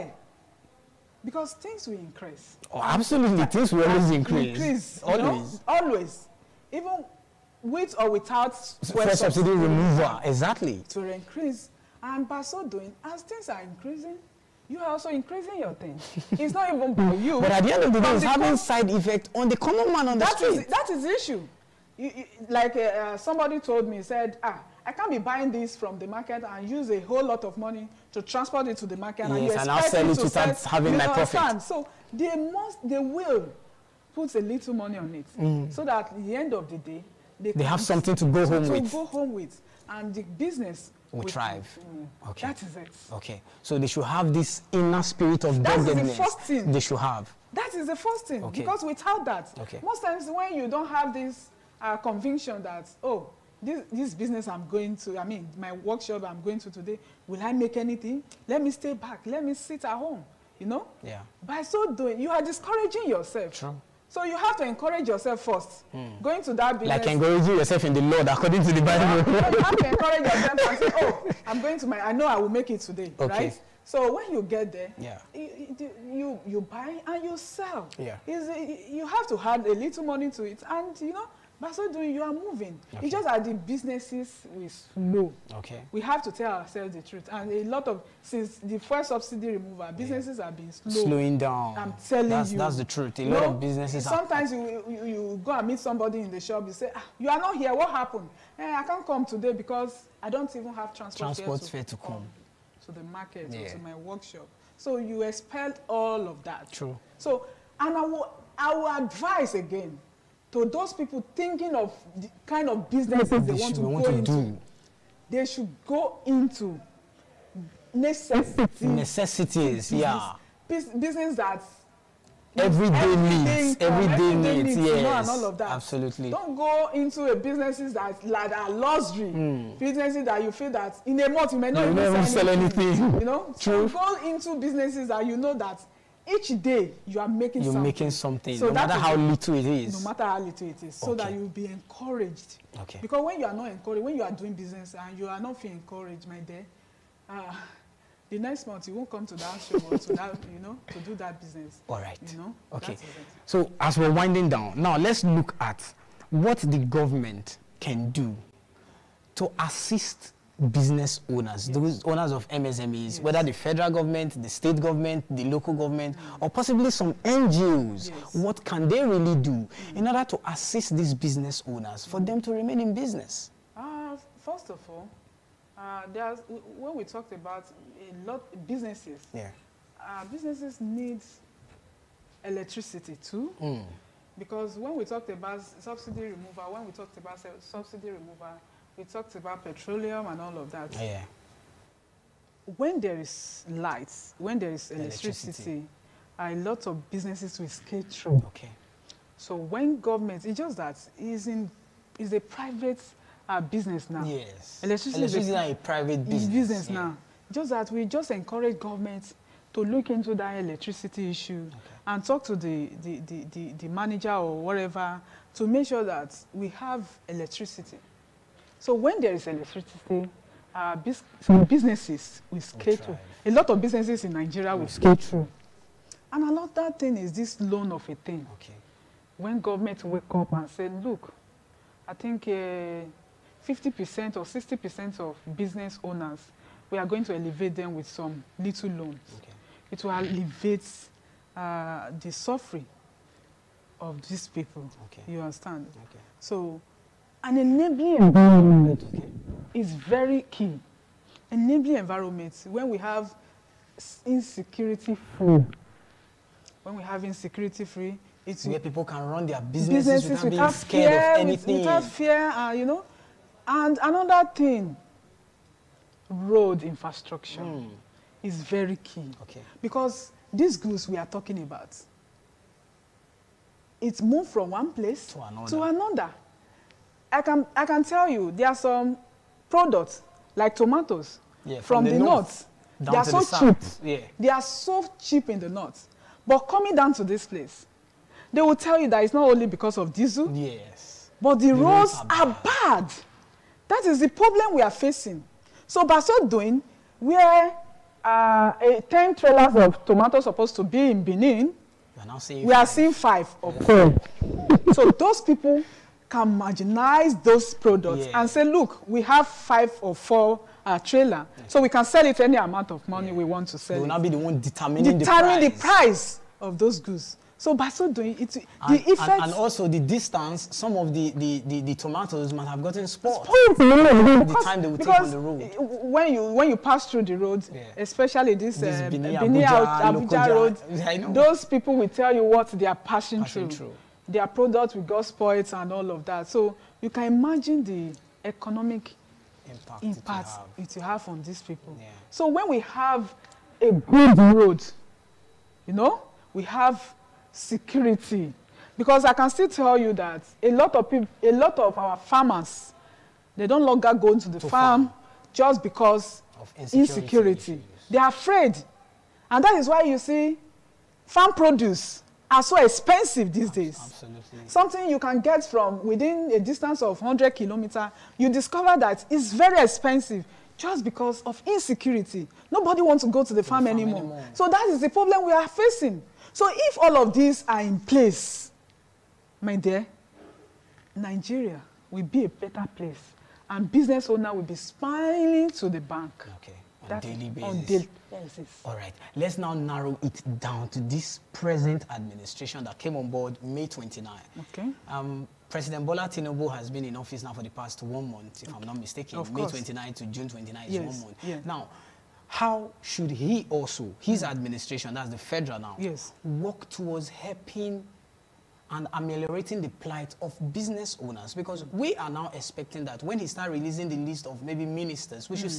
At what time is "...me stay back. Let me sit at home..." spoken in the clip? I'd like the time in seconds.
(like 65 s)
58 s.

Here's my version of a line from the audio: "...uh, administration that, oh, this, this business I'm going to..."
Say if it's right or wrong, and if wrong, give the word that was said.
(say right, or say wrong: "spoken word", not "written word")
wrong: "conviction", not "administration".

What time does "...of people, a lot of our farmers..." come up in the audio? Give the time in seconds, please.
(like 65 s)
350 s.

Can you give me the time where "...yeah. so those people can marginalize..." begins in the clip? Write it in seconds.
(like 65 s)
303 s.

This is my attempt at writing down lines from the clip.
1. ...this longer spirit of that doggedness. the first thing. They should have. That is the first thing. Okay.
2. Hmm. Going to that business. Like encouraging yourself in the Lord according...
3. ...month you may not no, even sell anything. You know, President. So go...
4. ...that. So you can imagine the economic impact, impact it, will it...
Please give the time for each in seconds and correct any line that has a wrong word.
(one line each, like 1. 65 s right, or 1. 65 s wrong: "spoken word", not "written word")
1. 44 s wrong: "inner", not "longer"
2. 65 s right
3. 131 s wrong: "True", not "President"
4. 336 s right.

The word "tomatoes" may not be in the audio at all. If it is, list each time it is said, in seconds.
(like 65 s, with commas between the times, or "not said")
280 s, 300 s, 321 s.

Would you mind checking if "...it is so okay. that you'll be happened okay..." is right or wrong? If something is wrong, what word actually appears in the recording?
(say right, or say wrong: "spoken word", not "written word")
wrong: "encouraged", not "happened".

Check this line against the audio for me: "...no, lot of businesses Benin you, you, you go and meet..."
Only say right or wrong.
wrong.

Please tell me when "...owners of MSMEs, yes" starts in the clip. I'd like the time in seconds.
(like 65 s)
162 s.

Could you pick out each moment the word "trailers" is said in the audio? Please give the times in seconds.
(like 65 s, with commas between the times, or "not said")
299 s, 310 s.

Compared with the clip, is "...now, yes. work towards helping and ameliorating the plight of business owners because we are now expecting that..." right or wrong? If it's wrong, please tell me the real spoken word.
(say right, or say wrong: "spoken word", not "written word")
right.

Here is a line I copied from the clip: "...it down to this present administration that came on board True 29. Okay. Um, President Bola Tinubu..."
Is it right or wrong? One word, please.
wrong.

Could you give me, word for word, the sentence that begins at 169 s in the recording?
in order to assist these business owners for them to remain in business?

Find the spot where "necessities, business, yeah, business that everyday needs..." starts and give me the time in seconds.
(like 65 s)
118 s.